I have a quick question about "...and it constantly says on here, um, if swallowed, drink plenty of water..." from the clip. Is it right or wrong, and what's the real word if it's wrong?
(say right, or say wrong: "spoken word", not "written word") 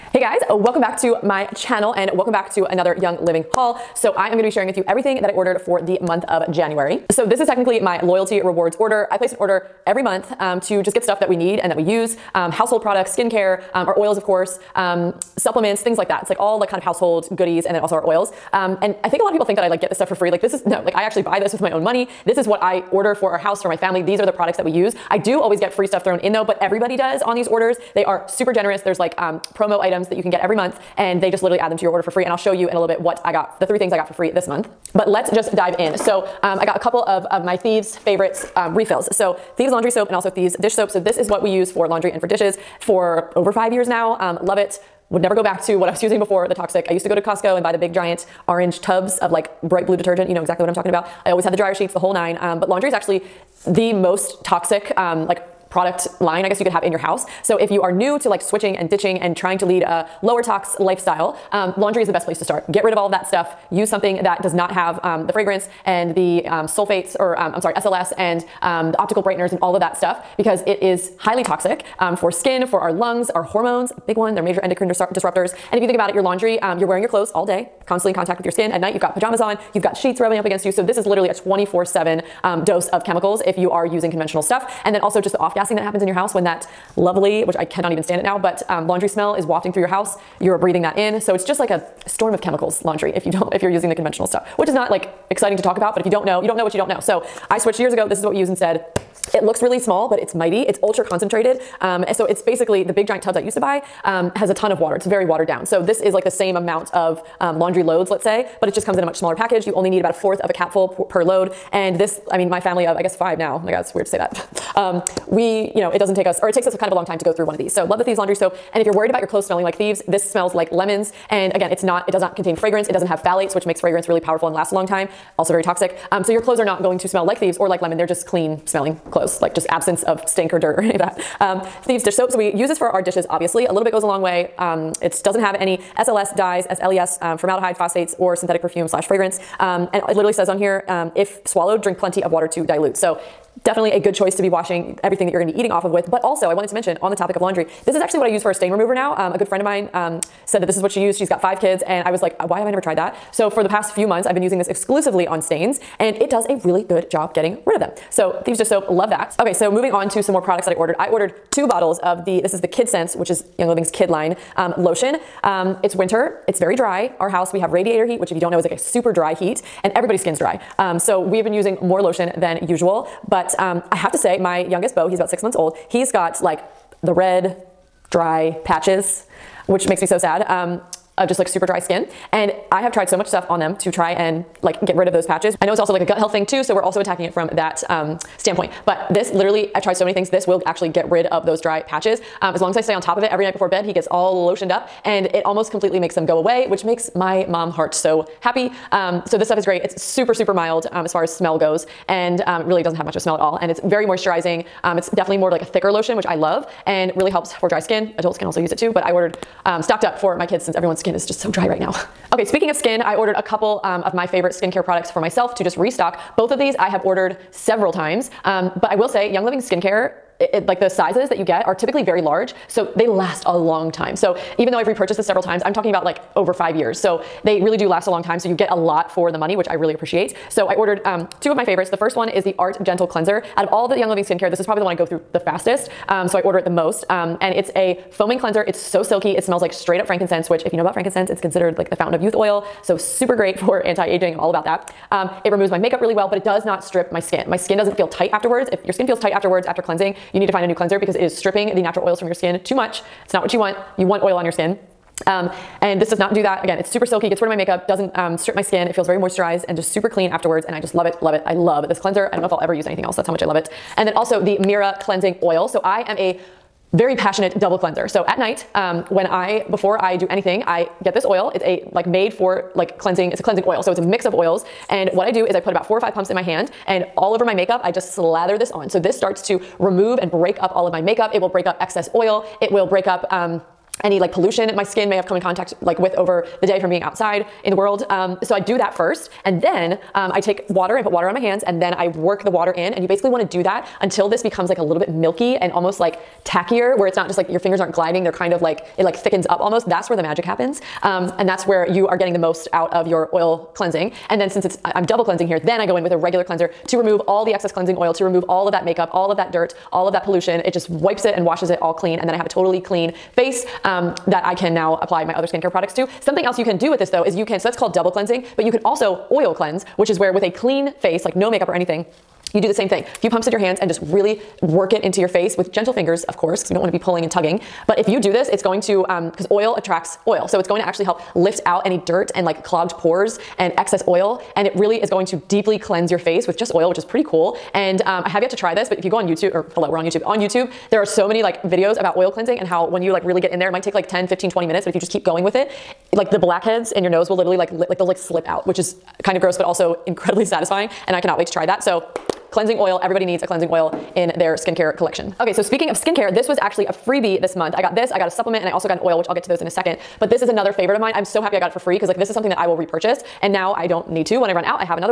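wrong: "literally", not "constantly".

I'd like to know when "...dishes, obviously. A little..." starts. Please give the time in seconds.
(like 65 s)
133 s.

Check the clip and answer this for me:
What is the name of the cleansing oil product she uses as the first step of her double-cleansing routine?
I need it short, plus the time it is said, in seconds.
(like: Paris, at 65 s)
Mirah, at 264 s.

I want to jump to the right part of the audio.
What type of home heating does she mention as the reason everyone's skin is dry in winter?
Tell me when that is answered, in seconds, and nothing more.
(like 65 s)
167 s.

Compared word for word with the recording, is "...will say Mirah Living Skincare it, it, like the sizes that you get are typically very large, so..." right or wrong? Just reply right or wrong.
wrong.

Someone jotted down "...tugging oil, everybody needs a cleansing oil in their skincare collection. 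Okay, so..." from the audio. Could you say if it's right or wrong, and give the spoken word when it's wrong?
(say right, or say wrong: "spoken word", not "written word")
wrong: "cleansing", not "tugging".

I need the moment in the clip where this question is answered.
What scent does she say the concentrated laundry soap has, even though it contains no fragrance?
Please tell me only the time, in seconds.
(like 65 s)
120 s.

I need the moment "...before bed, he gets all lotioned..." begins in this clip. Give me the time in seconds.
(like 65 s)
193 s.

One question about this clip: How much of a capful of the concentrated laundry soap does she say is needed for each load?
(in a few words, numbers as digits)
a fourth.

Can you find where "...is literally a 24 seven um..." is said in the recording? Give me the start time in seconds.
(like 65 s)
80 s.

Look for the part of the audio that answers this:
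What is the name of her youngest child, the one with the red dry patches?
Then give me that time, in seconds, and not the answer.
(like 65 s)
174 s.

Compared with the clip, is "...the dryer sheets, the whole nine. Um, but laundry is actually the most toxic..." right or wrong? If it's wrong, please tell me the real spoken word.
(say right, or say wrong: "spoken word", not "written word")
right.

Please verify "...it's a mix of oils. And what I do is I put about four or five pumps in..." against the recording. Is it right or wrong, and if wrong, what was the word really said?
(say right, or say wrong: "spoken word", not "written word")
right.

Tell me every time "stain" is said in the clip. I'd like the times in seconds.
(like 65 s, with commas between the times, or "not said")
148 s, 155 s.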